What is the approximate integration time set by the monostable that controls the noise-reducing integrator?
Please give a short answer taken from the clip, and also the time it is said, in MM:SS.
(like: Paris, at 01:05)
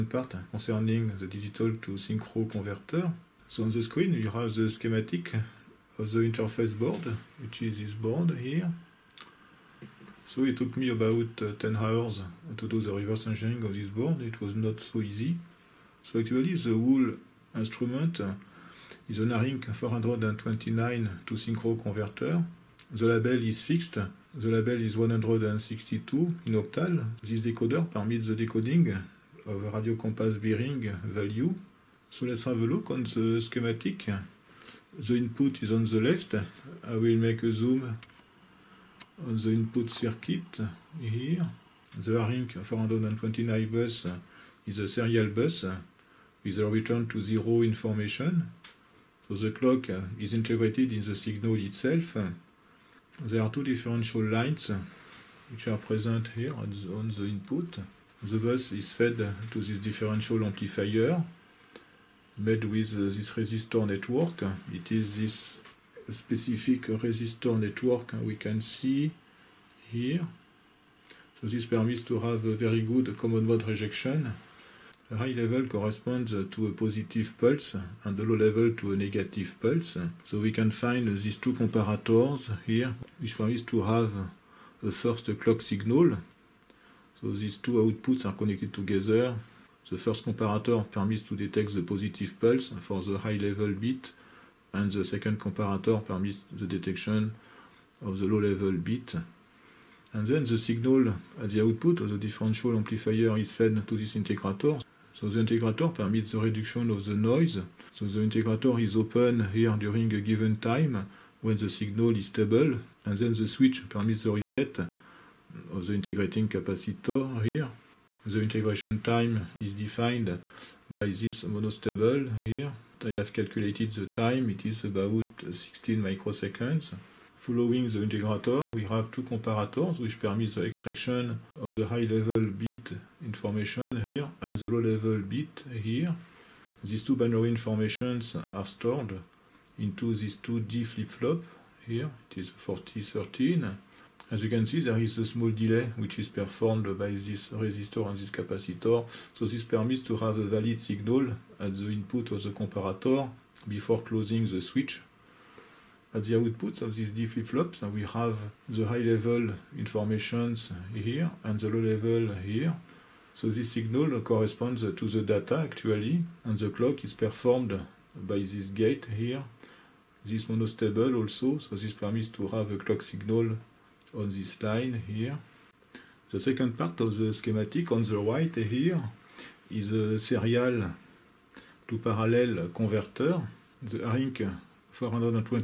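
16 microseconds, at 02:05.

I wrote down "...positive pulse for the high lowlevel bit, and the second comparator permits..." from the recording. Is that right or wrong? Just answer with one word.
wrong.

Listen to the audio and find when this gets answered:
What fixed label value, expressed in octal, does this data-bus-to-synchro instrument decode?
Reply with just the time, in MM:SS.
00:24.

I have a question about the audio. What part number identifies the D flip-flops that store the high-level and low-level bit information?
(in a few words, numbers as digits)
4013.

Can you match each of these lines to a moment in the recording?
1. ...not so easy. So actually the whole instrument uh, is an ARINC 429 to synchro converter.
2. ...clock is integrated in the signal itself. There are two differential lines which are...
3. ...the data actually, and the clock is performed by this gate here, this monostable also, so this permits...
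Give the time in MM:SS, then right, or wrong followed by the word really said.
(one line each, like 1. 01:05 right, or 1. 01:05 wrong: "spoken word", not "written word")
1. 00:14 right
2. 00:49 right
3. 02:45 right.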